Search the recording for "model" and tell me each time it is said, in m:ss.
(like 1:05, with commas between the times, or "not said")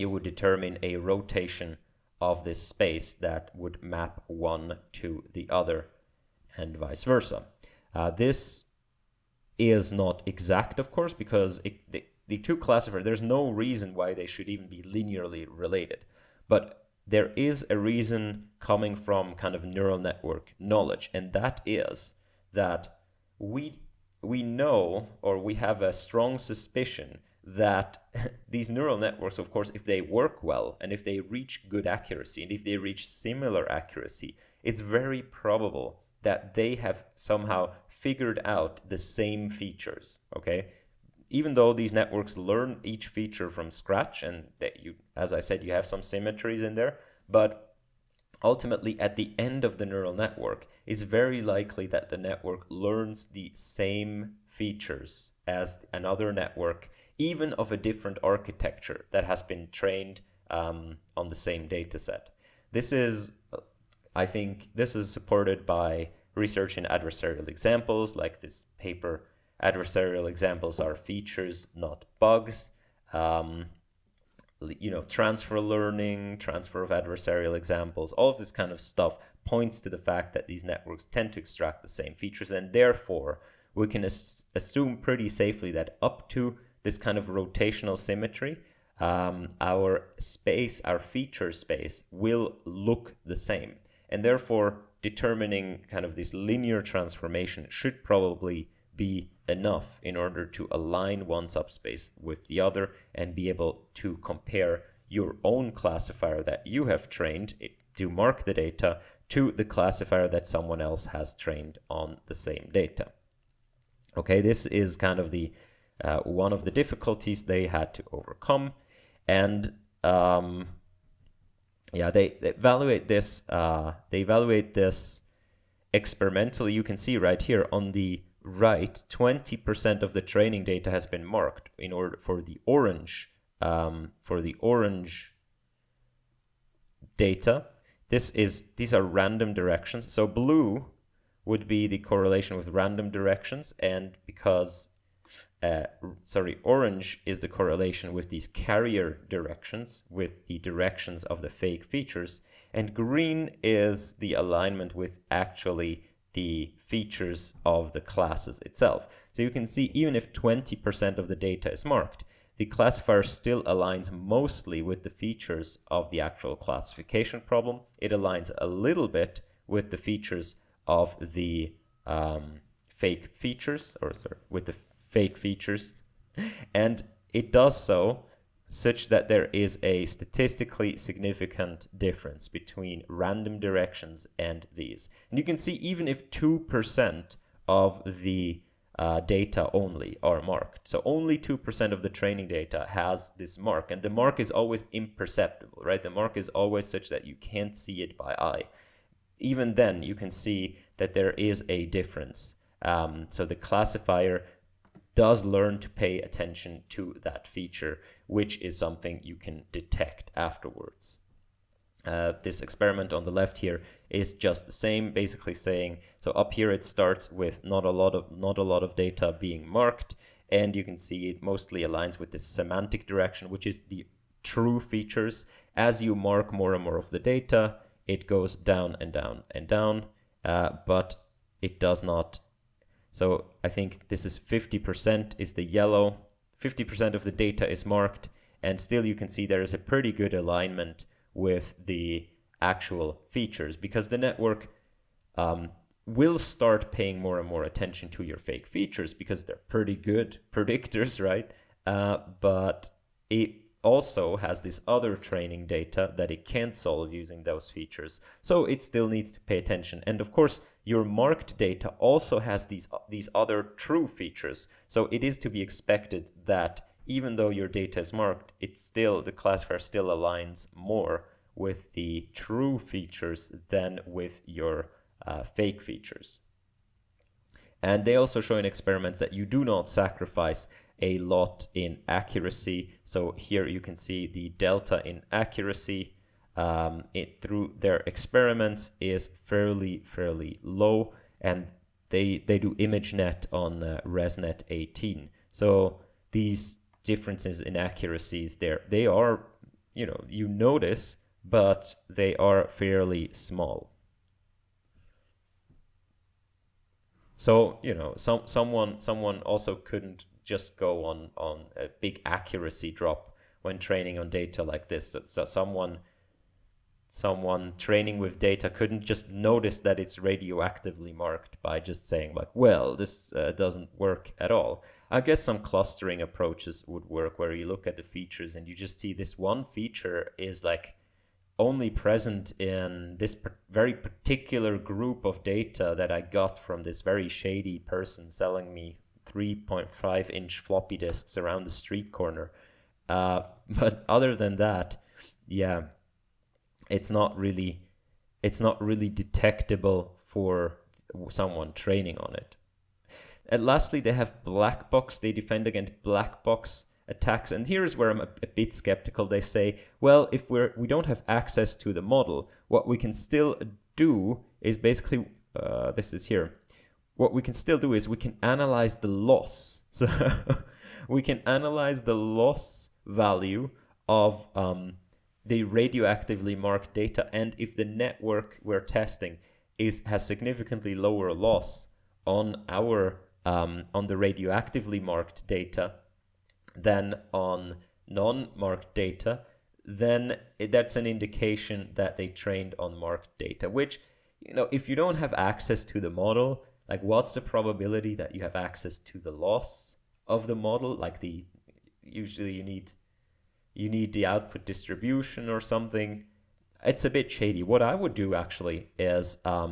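6:02, 6:36, 6:40.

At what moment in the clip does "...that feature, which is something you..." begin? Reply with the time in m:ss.
3:27.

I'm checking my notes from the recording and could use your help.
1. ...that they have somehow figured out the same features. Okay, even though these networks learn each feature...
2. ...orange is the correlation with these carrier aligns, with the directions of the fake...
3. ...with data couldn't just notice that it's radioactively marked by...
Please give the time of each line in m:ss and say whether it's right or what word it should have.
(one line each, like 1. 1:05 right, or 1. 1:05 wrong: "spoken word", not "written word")
1. 0:36 right
2. 2:26 wrong: "directions", not "aligns"
3. 5:18 right.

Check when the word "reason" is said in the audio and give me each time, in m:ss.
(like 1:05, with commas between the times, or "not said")
0:13, 0:17.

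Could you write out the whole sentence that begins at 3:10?
So only 2% of the training data has this mark and the mark is always imperceptible, right?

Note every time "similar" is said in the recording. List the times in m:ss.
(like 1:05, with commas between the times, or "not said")
0:33.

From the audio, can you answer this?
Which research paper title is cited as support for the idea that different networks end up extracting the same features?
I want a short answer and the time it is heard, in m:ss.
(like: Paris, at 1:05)
Adversarial examples are features, not bugs, at 1:09.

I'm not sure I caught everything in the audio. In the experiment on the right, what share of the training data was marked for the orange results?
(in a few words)
20%.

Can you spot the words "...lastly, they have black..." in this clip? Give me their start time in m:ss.
5:53.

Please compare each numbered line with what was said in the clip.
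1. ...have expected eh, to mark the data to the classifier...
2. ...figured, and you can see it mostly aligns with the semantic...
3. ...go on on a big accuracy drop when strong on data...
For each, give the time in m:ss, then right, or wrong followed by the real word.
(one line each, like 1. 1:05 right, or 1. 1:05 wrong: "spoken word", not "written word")
1. 1:46 wrong: "trained", not "expected"
2. 3:39 wrong: "marked", not "figured"
3. 5:10 wrong: "training", not "strong".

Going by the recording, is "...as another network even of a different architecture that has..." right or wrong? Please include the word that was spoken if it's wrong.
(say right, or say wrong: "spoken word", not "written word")
right.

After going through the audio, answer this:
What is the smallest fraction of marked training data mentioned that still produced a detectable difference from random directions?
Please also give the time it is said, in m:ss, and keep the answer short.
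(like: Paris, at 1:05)
2%, at 3:06.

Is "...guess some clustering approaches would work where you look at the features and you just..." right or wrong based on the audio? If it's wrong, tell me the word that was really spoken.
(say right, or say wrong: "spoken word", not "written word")
right.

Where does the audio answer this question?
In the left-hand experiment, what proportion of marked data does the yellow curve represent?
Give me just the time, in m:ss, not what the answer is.
3:54.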